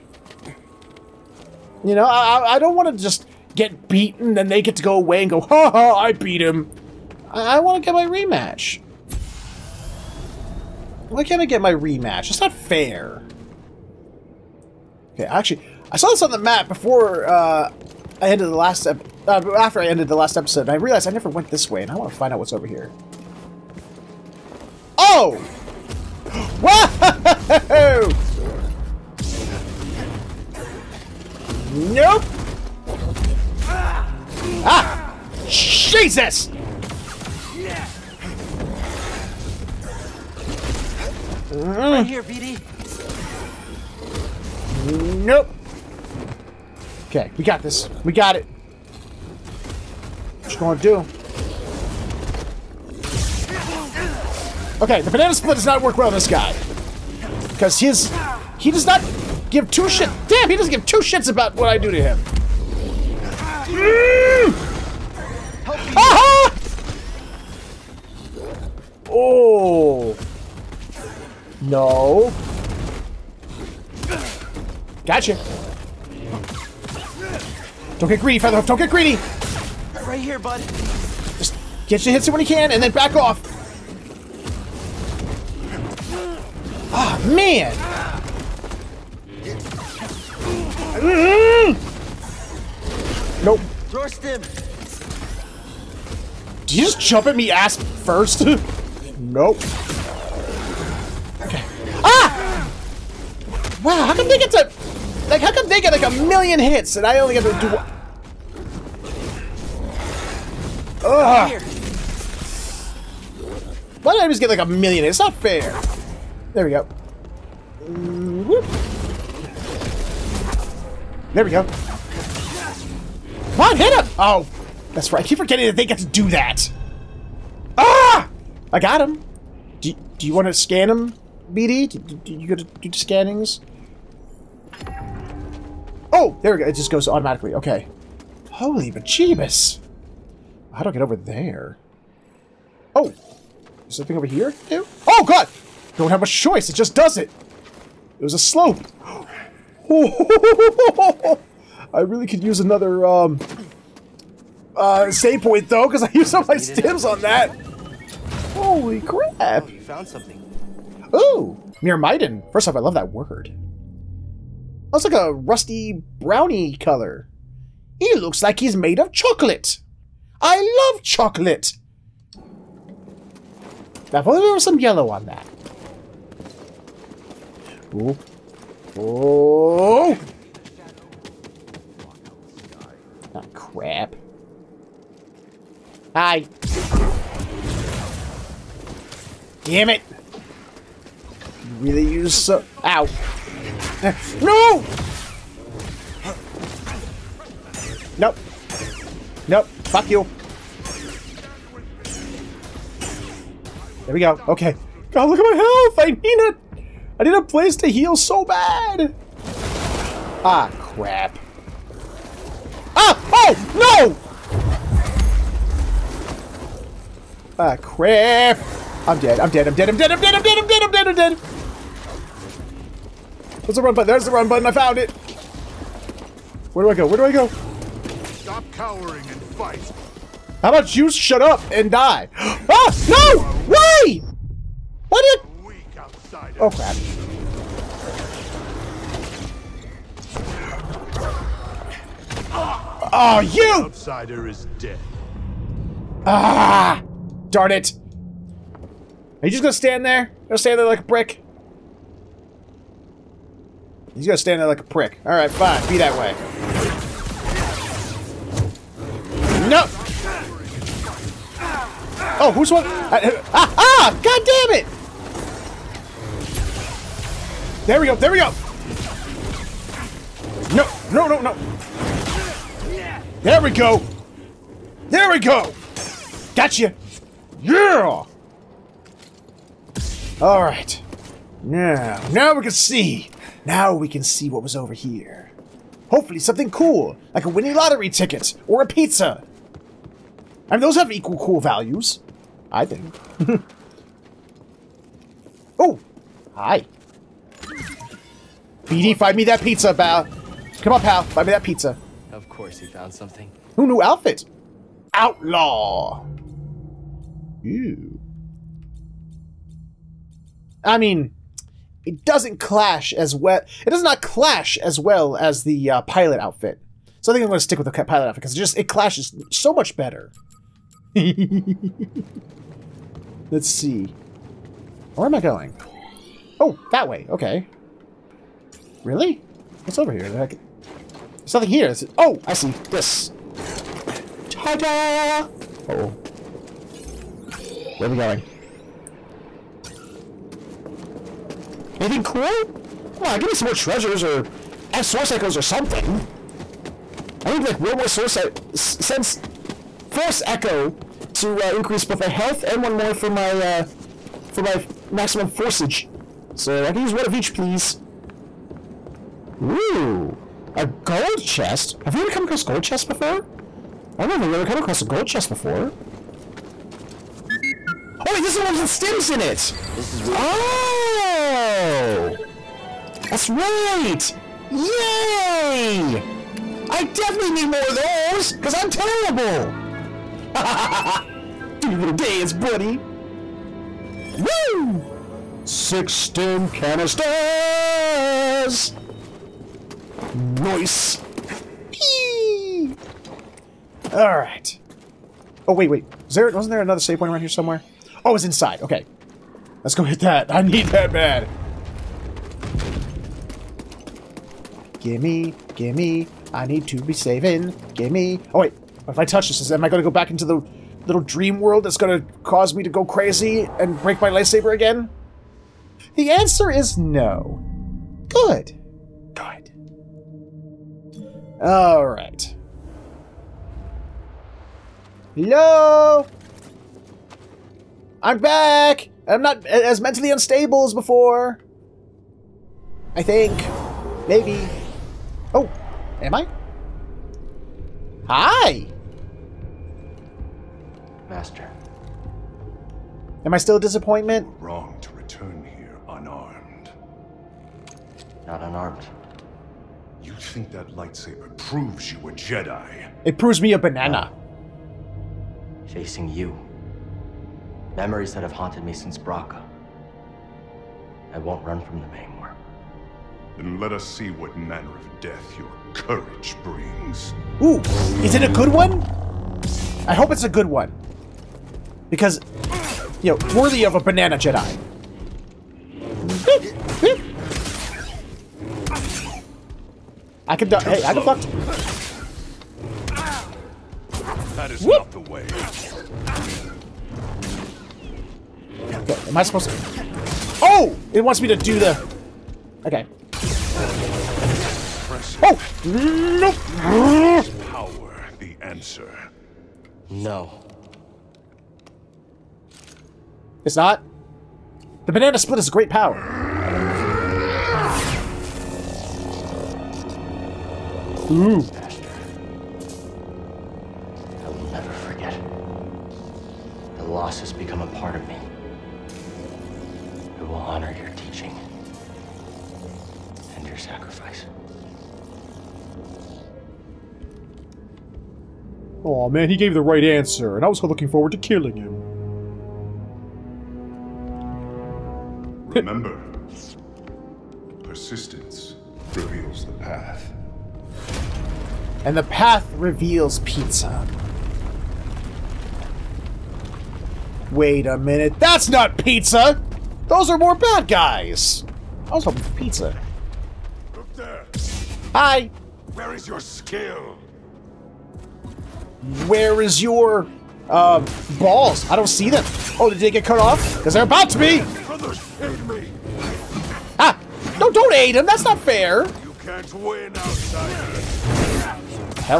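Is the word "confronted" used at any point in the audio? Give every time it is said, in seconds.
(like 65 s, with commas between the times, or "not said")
not said.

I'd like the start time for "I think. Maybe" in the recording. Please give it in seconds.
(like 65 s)
433 s.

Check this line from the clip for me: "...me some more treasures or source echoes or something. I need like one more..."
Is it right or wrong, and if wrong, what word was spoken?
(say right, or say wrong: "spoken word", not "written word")
right.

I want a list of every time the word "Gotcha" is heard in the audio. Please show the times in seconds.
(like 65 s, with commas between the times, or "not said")
75 s, 276 s.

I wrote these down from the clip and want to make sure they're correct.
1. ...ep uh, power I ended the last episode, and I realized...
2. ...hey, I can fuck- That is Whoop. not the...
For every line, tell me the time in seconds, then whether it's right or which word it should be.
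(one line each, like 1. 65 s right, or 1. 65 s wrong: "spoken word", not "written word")
1. 18 s wrong: "after", not "power"
2. 480 s right.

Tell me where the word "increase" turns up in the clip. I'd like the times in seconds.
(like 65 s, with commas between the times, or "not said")
351 s.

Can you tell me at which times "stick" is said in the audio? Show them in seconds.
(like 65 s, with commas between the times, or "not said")
317 s.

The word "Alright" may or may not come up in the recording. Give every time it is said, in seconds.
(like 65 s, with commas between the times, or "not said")
255 s, 280 s, 394 s.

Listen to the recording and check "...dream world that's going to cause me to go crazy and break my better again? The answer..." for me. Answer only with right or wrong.
wrong.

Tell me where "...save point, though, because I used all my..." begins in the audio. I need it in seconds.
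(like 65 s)
155 s.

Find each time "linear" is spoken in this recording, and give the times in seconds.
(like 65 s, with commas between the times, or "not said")
not said.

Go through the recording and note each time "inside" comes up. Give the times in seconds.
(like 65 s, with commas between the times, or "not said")
398 s.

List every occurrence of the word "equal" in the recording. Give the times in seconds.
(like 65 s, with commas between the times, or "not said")
291 s.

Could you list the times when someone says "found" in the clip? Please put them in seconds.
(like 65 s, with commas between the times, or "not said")
159 s, 224 s, 302 s.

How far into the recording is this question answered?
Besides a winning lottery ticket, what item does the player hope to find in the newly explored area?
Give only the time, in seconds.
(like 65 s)
288 s.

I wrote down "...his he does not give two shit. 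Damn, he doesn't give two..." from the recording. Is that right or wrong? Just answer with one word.
right.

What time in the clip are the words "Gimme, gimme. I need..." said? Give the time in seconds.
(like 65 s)
405 s.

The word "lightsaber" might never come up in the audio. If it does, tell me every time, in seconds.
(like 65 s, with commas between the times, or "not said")
414 s, 450 s.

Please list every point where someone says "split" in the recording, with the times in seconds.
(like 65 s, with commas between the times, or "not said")
55 s, 505 s.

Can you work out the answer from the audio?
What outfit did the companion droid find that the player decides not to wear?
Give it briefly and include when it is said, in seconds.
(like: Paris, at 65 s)
Outlaw, at 305 s.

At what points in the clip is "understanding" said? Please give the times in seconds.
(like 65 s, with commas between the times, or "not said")
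not said.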